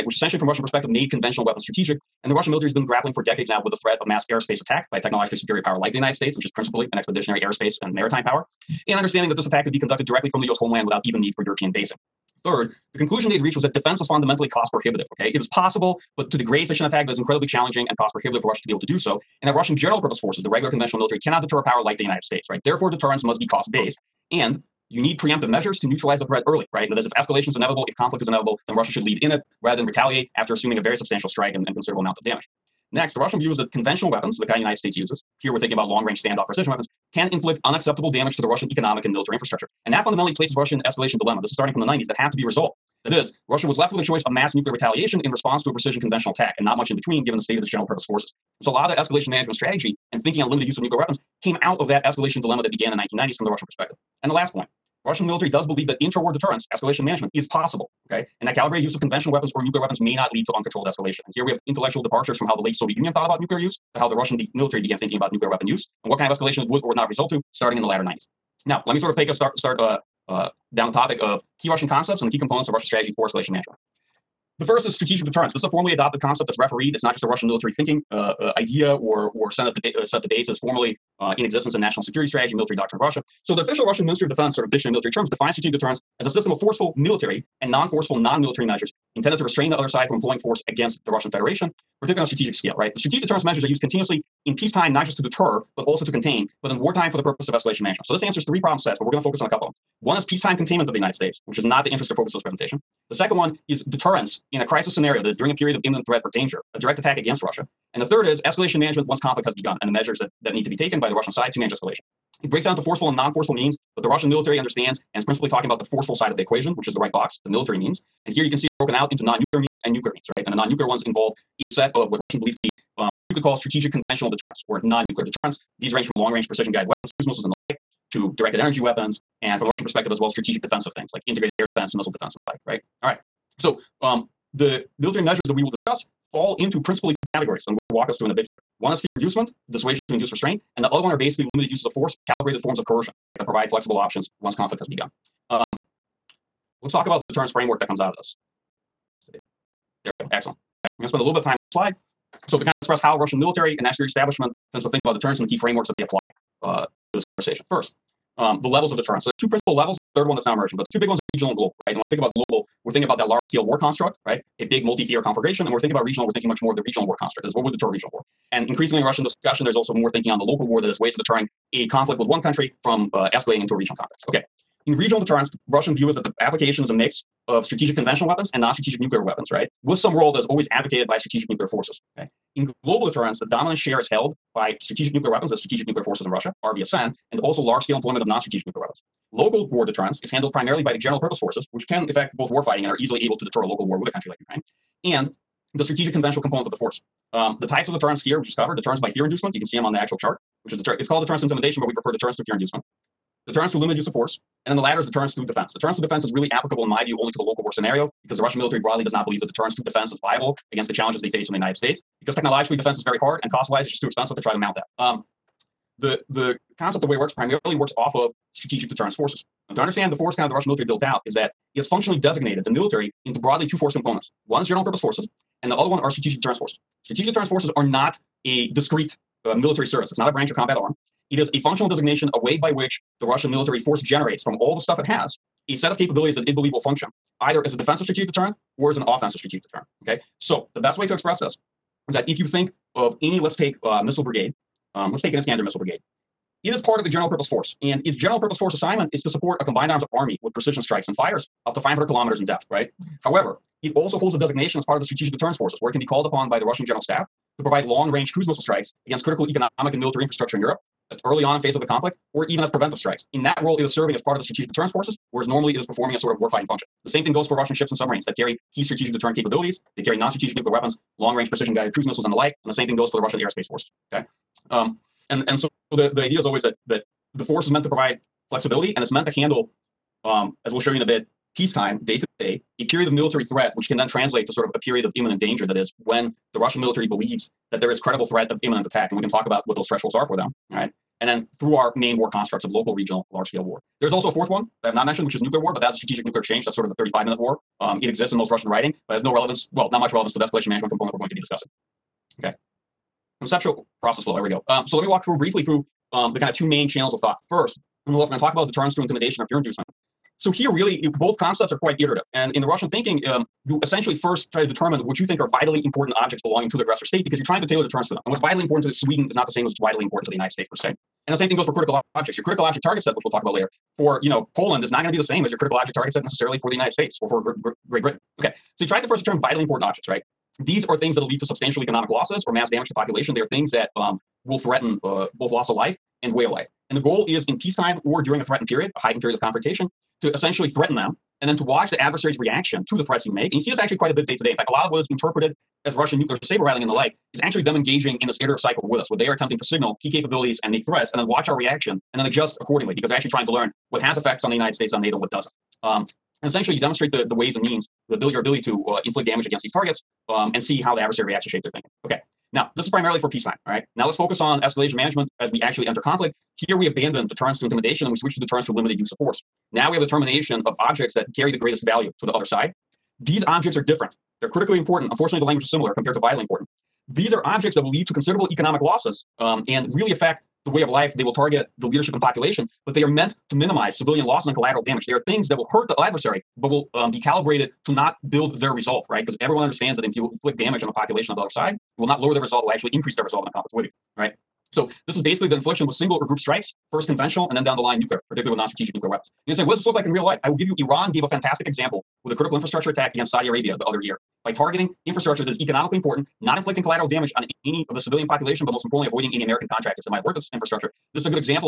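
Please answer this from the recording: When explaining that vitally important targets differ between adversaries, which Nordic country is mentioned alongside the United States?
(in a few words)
Sweden.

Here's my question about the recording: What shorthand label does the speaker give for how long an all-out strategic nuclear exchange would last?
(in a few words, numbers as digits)
35 minutes.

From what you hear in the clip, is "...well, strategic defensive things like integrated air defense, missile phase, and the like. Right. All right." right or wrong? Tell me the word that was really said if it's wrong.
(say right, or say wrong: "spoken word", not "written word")
wrong: "defense", not "phase".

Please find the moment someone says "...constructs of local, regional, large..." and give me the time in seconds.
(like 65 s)
292 s.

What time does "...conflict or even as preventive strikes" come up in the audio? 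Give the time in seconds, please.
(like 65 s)
261 s.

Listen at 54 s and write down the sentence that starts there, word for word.
And the last point, Russian military does believe that intra-war war deterrence, escalation management, is possible, okay?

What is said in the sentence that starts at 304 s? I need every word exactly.
Um, so let me walk through briefly through um, the kind of two main channels of thought.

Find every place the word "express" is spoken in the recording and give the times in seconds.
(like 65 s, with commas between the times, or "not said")
152 s, 241 s.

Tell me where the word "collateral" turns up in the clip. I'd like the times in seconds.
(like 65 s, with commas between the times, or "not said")
384 s, 406 s.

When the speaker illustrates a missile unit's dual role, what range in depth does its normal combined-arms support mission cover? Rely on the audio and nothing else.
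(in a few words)
500 kilometers.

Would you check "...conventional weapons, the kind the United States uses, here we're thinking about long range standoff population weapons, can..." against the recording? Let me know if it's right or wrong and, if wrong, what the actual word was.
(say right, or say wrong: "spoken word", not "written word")
wrong: "precision", not "population".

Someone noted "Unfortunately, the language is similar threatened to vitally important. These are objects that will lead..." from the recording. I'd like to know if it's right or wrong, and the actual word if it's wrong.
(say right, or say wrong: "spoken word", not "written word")
wrong: "compared", not "threatened".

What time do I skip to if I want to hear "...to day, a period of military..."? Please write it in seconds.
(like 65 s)
282 s.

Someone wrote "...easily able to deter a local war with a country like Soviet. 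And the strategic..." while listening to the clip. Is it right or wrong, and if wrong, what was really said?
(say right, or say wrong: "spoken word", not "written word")
wrong: "Ukraine", not "Soviet".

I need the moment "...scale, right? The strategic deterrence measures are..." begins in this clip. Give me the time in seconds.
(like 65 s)
92 s.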